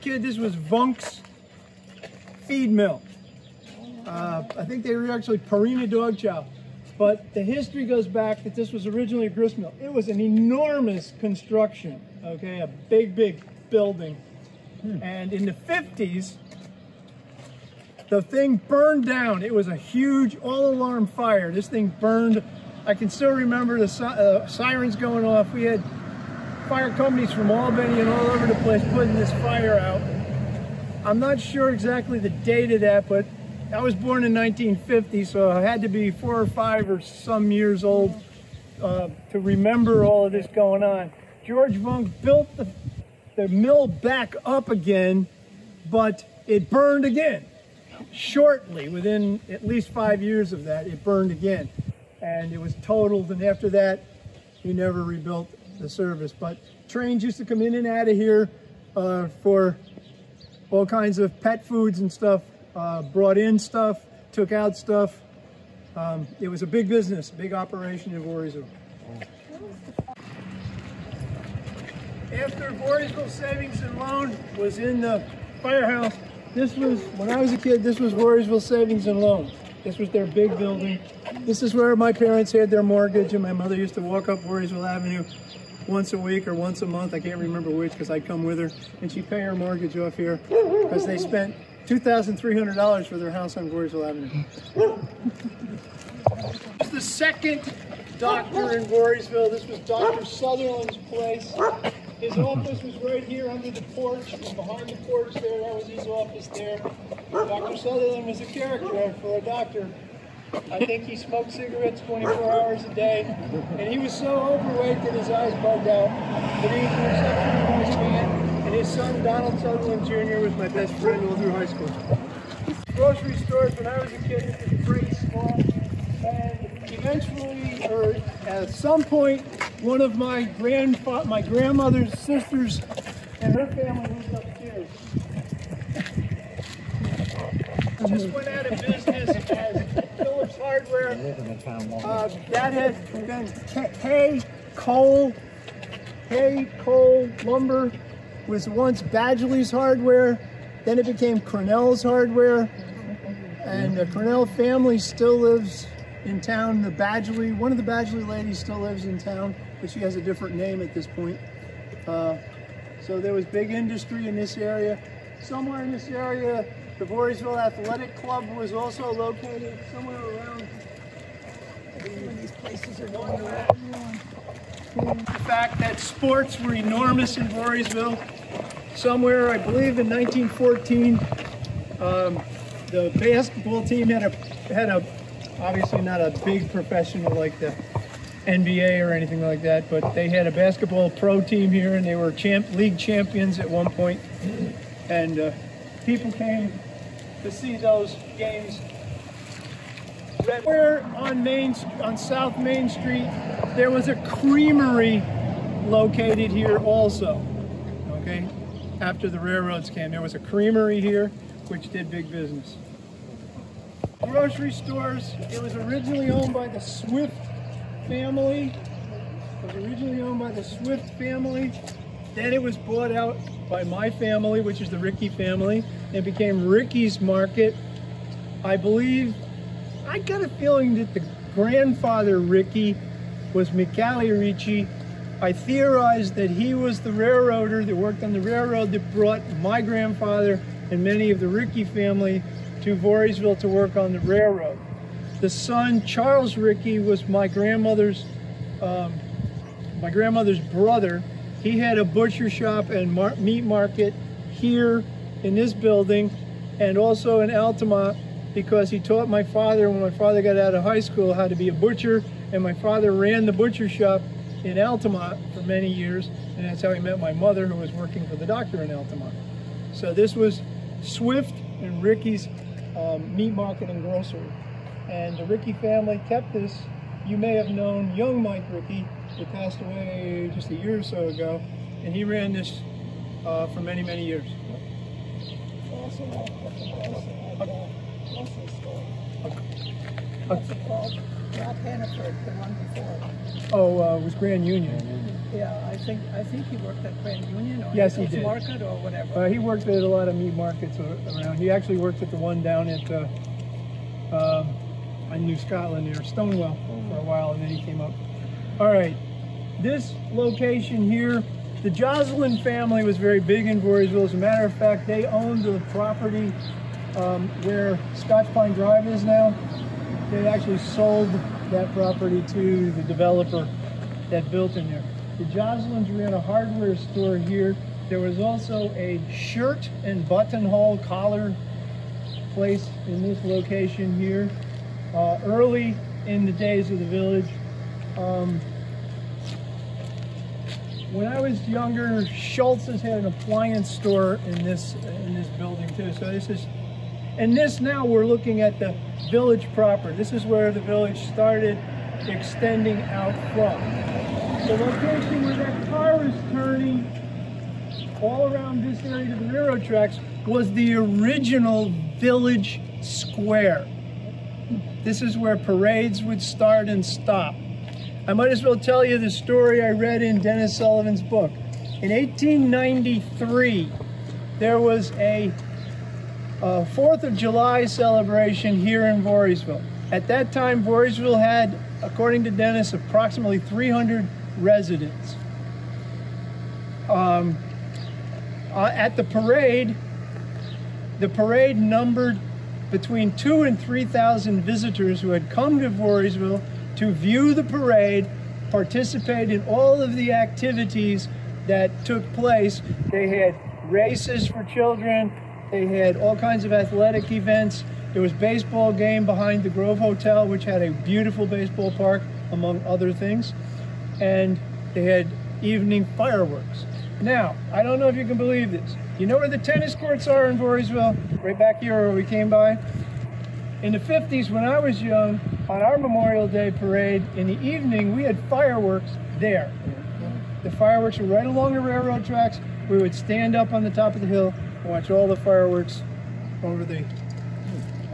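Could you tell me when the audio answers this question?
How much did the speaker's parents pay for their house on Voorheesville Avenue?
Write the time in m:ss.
1:31.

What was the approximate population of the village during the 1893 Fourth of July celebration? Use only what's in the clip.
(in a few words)
300.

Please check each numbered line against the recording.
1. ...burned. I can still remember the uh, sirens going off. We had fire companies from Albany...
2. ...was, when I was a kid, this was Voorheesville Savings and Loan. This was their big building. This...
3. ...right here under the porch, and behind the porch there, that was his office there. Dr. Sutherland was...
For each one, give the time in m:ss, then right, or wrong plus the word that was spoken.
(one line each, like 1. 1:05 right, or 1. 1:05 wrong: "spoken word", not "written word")
1. 0:21 right
2. 1:16 right
3. 1:42 right.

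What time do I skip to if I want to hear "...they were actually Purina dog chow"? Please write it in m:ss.
0:04.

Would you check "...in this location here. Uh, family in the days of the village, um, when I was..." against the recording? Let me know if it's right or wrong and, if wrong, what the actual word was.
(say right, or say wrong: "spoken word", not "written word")
wrong: "early", not "family".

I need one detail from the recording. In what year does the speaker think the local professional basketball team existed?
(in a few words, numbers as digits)
1914.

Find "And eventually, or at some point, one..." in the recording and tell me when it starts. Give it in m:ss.
2:06.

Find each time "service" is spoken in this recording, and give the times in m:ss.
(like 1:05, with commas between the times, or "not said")
0:55.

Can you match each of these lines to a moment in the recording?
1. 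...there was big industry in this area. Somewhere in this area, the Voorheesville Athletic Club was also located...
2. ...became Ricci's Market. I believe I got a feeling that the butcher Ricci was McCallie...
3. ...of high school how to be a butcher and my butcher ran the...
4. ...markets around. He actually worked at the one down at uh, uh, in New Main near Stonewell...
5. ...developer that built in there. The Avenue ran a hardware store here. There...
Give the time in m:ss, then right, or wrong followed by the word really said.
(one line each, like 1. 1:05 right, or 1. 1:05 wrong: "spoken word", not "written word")
1. 2:43 right
2. 3:46 wrong: "grandfather", not "butcher"
3. 4:20 wrong: "father", not "butcher"
4. 5:00 wrong: "Scotland", not "Main"
5. 5:23 wrong: "Joslins", not "Avenue".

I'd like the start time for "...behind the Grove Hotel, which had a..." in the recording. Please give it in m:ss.
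6:49.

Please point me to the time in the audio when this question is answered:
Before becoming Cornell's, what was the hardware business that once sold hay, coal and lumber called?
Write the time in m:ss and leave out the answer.
2:29.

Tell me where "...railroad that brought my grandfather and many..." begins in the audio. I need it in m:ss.
3:58.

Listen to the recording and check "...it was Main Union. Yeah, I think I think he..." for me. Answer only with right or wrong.
wrong.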